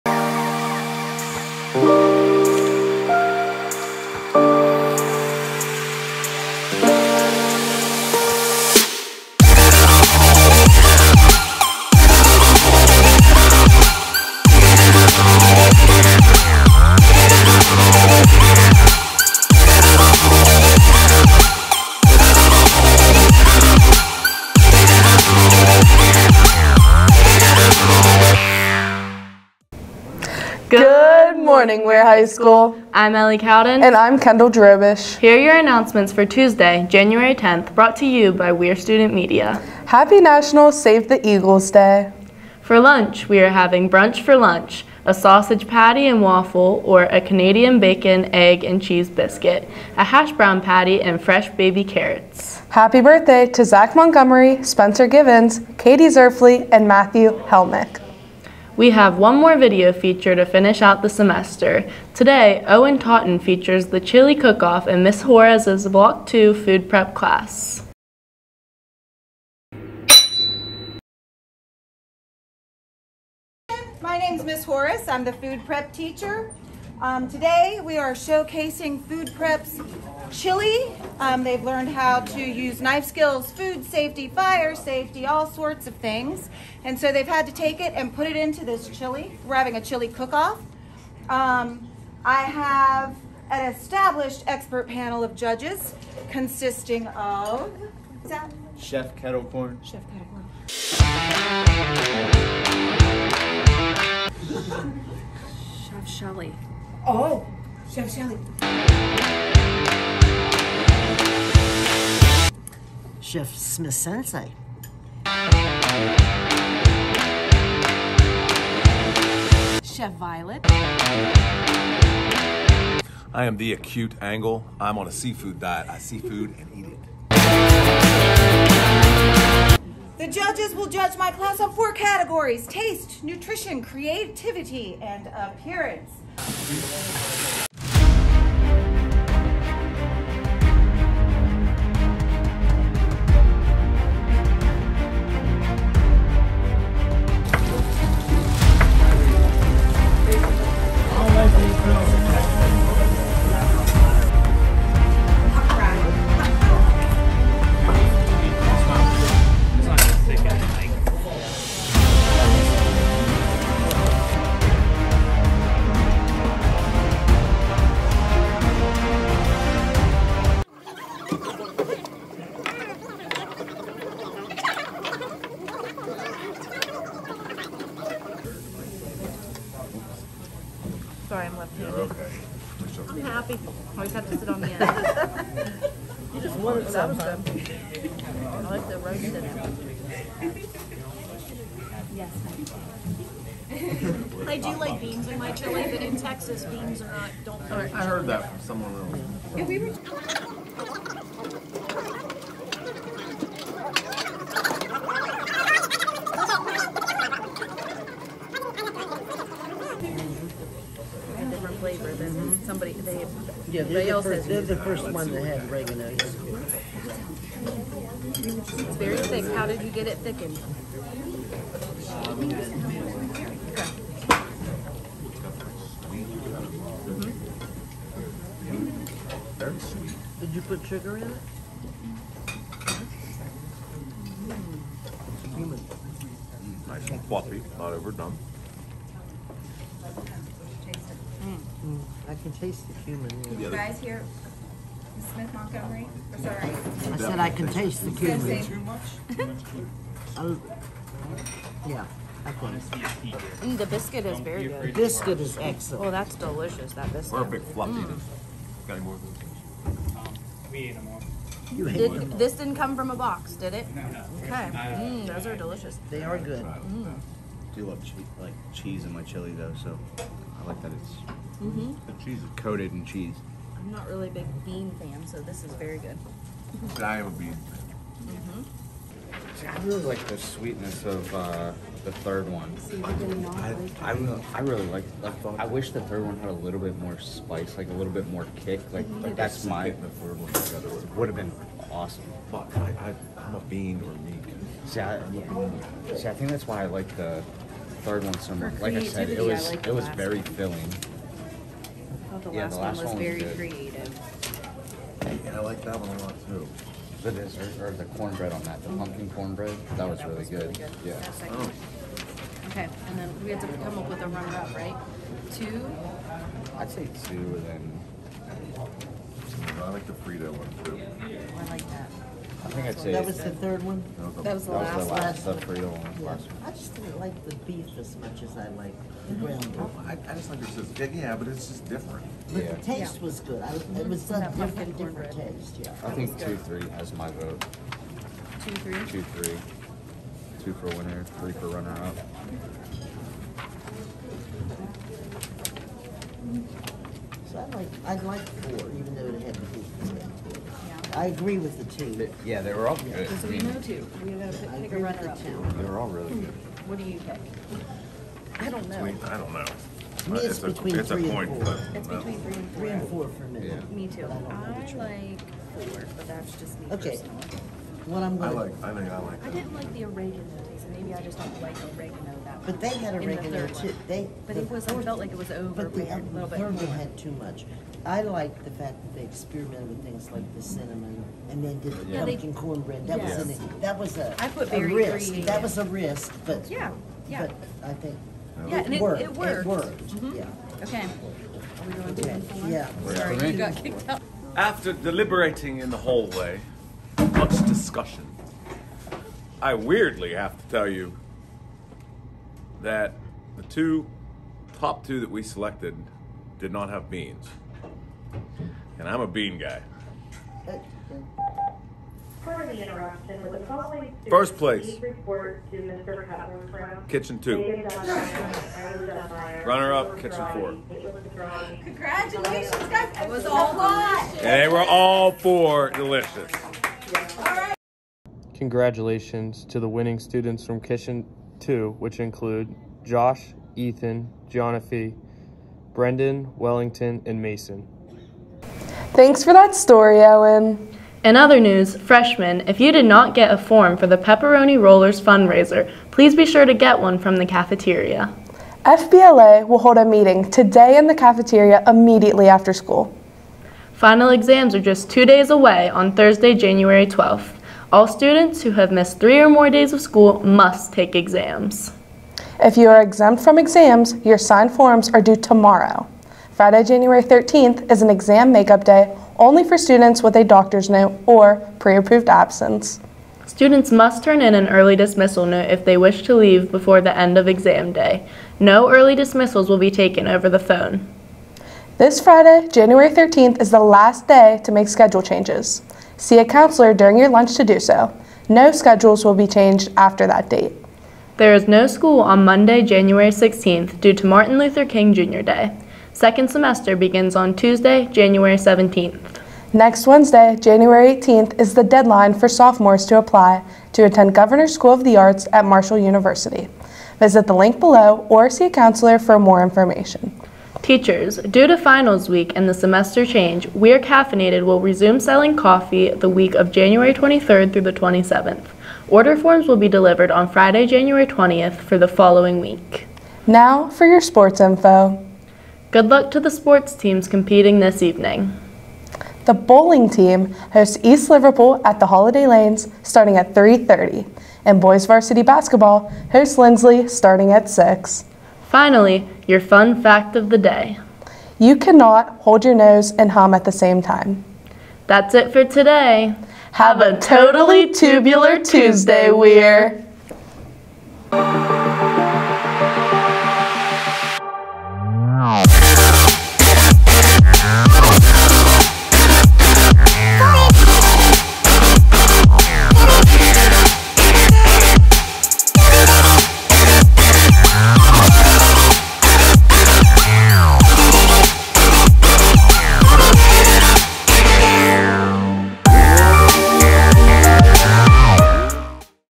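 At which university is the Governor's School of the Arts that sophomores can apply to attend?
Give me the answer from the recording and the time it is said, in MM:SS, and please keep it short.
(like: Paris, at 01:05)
Marshall University, at 08:25.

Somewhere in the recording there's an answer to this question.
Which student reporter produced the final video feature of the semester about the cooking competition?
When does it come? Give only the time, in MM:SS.
01:02.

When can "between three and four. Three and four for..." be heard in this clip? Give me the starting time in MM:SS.
06:02.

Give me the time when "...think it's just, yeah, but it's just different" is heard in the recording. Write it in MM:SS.
05:30.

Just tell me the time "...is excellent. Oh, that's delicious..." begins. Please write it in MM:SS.
04:15.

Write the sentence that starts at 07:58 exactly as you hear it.
No early dismissals will be taken over the phone.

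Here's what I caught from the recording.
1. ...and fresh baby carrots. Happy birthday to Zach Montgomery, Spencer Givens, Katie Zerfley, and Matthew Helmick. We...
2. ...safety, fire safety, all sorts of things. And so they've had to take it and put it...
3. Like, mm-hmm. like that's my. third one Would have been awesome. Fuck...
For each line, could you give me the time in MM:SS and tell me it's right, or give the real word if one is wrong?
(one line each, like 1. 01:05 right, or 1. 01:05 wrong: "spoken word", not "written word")
1. 00:51 right
2. 01:23 right
3. 04:48 right.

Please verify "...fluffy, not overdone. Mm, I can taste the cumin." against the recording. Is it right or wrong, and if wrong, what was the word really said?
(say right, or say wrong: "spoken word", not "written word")
right.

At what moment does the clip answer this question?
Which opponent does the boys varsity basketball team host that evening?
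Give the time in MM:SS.
08:56.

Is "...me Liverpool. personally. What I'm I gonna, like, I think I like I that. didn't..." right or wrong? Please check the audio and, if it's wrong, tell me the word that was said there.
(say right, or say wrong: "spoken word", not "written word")
wrong: "Okay", not "Liverpool".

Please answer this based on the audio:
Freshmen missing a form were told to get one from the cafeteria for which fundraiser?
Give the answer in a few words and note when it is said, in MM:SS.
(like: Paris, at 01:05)
Pepperoni Rollers, at 07:24.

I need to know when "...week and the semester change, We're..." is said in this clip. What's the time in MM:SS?
08:32.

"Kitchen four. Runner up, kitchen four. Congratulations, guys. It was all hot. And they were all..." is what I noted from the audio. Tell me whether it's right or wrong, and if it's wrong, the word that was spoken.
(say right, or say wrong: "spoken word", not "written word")
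wrong: "two", not "four".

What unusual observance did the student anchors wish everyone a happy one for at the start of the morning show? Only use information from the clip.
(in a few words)
National Save the Eagles Day.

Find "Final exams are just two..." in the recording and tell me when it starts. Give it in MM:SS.
07:33.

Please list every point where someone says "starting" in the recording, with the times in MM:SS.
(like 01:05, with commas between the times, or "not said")
08:53, 08:57.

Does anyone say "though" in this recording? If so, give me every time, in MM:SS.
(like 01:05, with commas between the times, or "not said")
04:29, 05:49.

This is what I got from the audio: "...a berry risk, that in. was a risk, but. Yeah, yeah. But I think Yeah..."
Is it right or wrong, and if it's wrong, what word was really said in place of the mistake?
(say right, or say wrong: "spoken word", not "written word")
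right.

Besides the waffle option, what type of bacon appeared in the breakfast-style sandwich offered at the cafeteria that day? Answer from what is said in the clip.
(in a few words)
Canadian bacon.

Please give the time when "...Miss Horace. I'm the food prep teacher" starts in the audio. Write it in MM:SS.
01:14.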